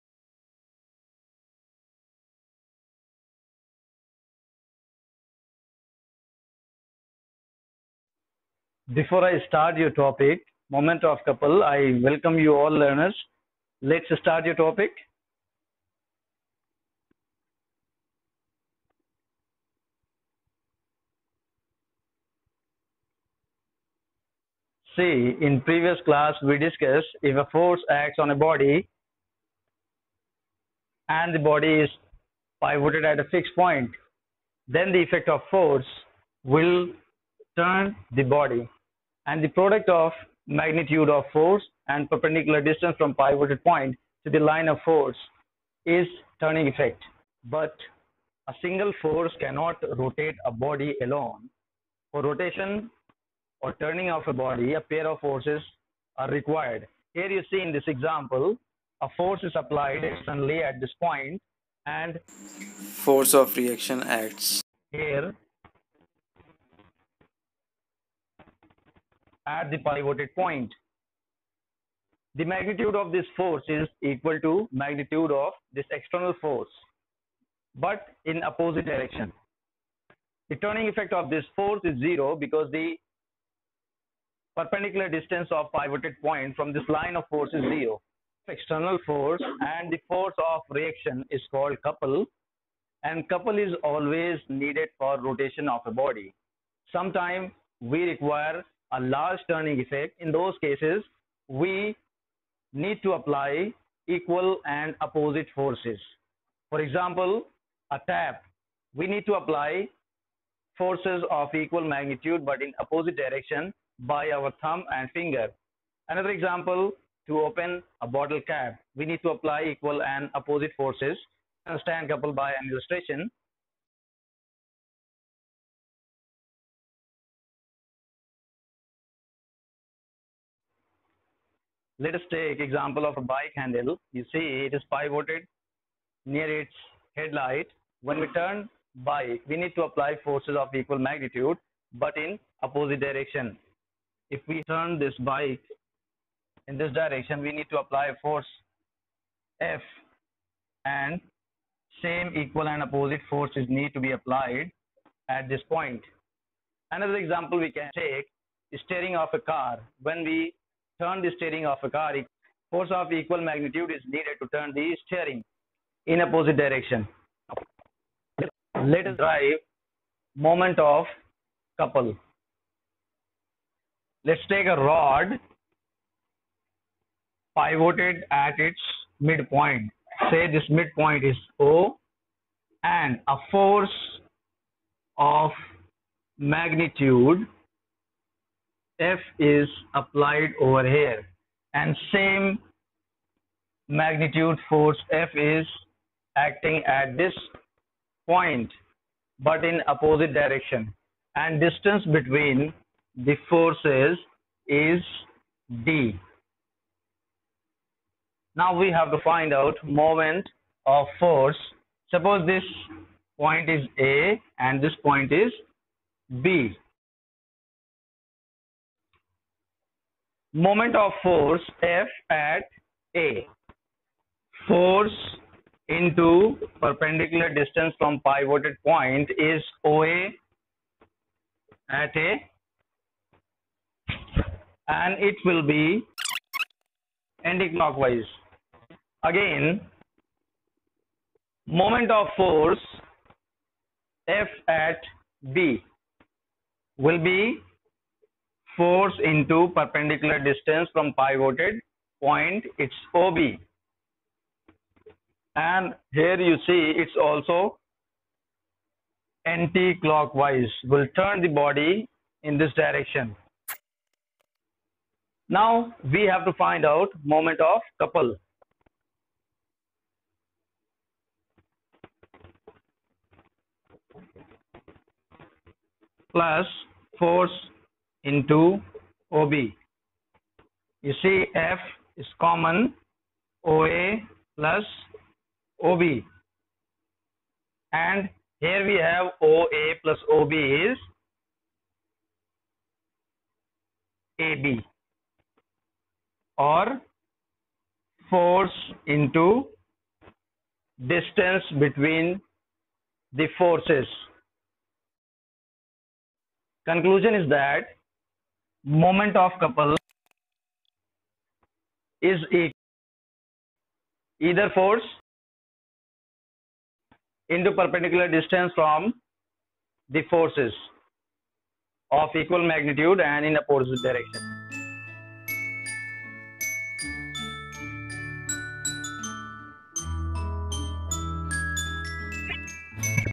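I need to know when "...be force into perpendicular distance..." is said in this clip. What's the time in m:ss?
4:07.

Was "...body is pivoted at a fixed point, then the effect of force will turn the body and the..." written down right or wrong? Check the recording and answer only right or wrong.
right.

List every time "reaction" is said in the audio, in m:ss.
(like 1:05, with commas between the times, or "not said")
1:03, 1:30.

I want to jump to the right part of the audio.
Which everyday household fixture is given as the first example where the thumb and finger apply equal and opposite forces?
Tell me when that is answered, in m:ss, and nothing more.
1:47.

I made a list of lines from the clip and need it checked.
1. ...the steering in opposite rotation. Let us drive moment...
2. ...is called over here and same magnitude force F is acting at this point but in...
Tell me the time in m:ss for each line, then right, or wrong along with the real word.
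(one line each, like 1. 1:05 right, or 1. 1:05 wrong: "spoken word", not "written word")
1. 2:44 wrong: "direction", not "rotation"
2. 3:09 wrong: "applied", not "called".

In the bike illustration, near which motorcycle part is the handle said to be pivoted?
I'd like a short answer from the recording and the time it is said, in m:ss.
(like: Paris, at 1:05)
headlight, at 2:17.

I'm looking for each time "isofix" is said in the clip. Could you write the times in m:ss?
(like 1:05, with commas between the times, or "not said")
not said.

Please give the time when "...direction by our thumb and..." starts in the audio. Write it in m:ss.
1:53.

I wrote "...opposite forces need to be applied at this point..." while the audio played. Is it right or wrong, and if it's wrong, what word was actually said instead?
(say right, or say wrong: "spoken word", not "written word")
right.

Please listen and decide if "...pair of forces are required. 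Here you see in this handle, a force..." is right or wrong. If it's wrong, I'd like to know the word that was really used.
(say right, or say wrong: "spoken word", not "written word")
wrong: "example", not "handle".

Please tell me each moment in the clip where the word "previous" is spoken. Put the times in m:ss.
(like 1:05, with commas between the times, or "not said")
0:25.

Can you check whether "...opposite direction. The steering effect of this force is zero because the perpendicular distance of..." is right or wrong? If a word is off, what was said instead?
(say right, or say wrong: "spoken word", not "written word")
wrong: "turning", not "steering".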